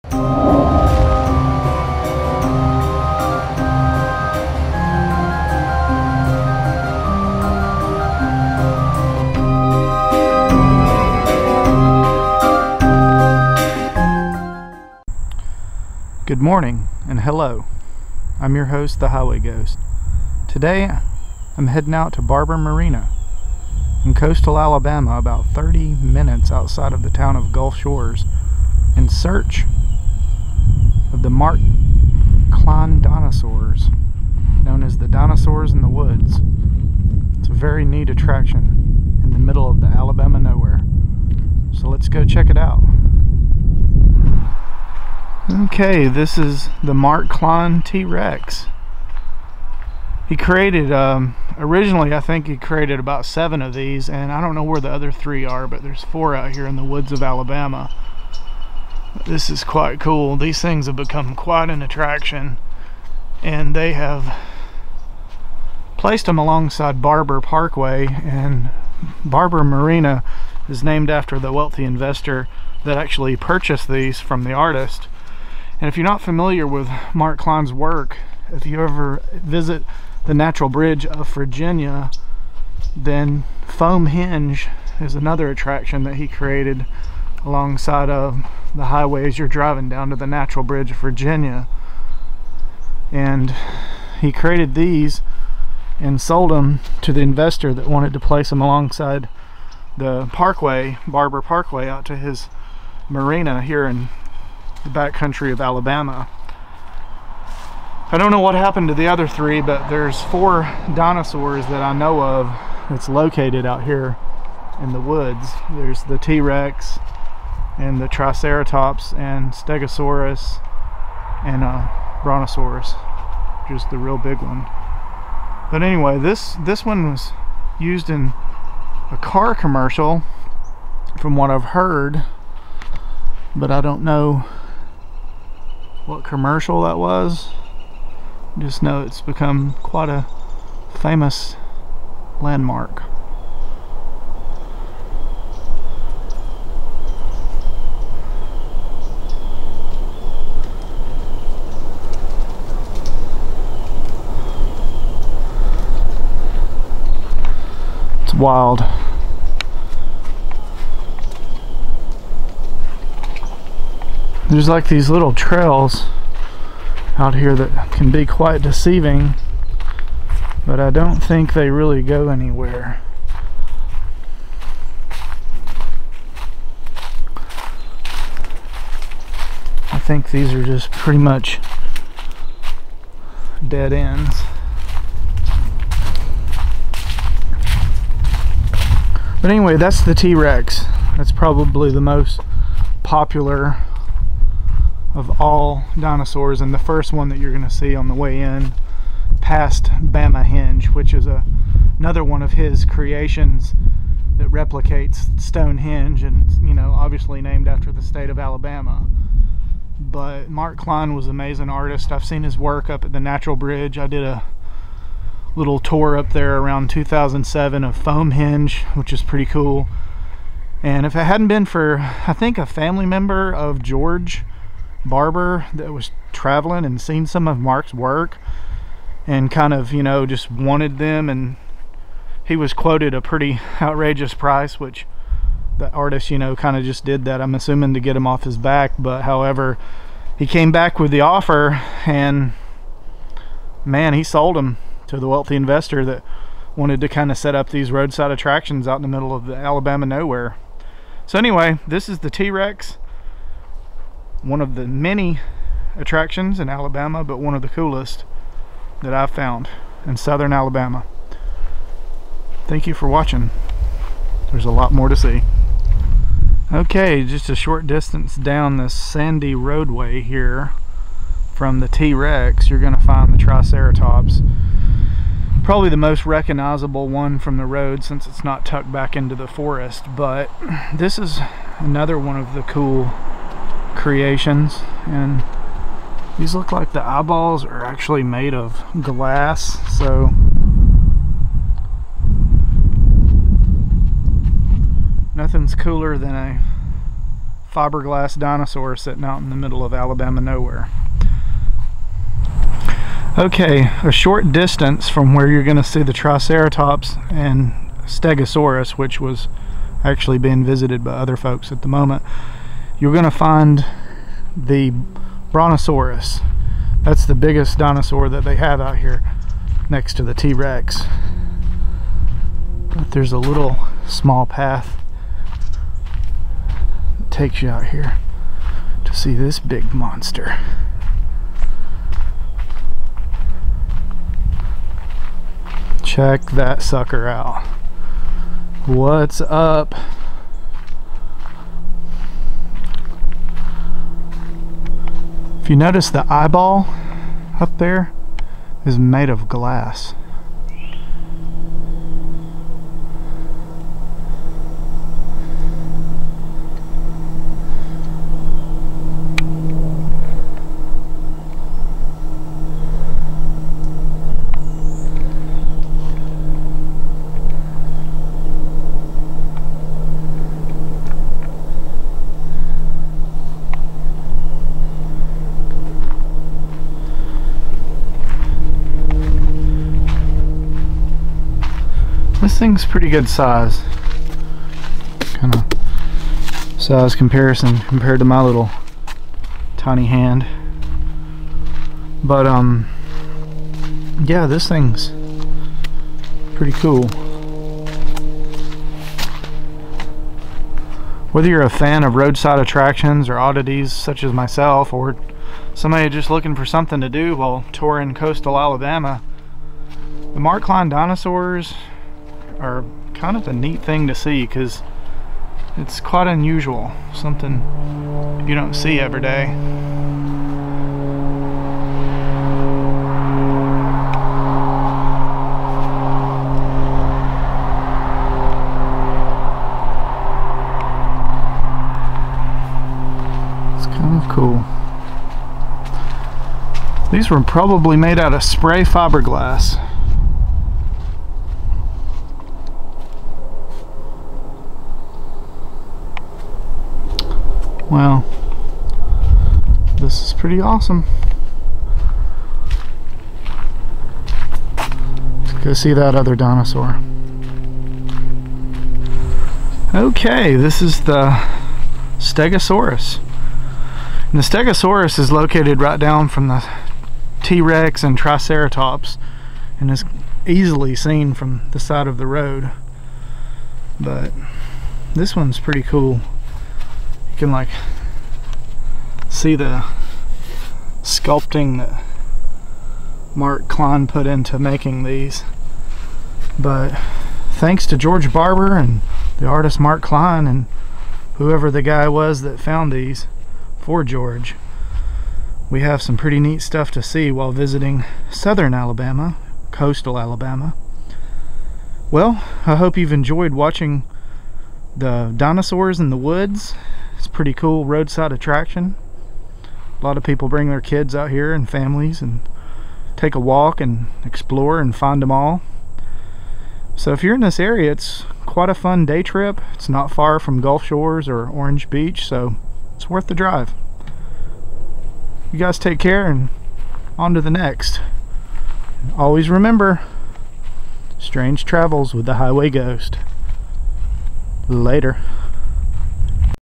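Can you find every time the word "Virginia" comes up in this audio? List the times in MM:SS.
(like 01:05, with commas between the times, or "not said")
01:21, 01:30.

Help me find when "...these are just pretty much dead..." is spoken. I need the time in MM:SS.
03:00.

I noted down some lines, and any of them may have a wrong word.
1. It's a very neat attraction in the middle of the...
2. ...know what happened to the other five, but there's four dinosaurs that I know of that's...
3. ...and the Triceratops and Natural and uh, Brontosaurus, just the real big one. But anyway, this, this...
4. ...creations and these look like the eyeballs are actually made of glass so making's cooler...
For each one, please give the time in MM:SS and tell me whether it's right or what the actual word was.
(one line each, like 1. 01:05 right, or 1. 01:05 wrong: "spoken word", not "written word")
1. 00:37 right
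2. 01:48 wrong: "three", not "five"
3. 01:57 wrong: "Stegosaurus", not "Natural"
4. 04:44 wrong: "nothing", not "making".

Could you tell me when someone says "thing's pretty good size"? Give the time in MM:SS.
06:22.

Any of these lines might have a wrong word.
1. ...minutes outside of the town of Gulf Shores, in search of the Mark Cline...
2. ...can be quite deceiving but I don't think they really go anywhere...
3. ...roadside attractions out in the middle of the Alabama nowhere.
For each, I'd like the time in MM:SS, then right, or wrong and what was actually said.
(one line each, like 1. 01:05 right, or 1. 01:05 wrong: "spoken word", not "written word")
1. 00:26 right
2. 02:47 right
3. 04:07 right.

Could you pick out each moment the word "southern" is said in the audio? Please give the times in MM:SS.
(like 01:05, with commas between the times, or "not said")
04:20, 08:18.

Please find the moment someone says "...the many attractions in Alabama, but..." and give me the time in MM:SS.
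04:14.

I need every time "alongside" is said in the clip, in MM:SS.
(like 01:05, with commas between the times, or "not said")
01:06, 01:27, 01:38.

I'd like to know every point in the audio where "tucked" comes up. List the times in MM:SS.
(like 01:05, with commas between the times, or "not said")
04:38.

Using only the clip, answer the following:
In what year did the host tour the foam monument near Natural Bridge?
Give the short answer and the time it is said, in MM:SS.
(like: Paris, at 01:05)
2007, at 03:36.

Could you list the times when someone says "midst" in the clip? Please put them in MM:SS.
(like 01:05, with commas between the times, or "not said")
not said.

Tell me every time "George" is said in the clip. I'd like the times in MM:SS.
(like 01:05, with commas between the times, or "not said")
03:43, 08:07, 08:14.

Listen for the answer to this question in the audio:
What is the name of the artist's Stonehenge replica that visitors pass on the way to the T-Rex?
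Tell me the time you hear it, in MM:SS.
03:20.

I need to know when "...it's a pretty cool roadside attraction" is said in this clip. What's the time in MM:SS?
08:27.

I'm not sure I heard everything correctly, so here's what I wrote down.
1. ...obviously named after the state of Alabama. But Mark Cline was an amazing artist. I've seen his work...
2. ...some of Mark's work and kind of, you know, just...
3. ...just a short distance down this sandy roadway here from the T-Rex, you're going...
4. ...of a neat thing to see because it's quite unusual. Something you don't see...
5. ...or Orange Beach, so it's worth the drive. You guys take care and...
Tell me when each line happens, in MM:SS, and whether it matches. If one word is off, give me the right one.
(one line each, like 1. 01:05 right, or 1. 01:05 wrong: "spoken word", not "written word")
1. 03:26 right
2. 03:47 right
3. 04:27 right
4. 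06:53 right
5. 08:41 right.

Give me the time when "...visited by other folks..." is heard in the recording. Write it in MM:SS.
05:10.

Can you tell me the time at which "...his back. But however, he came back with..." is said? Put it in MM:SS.
03:58.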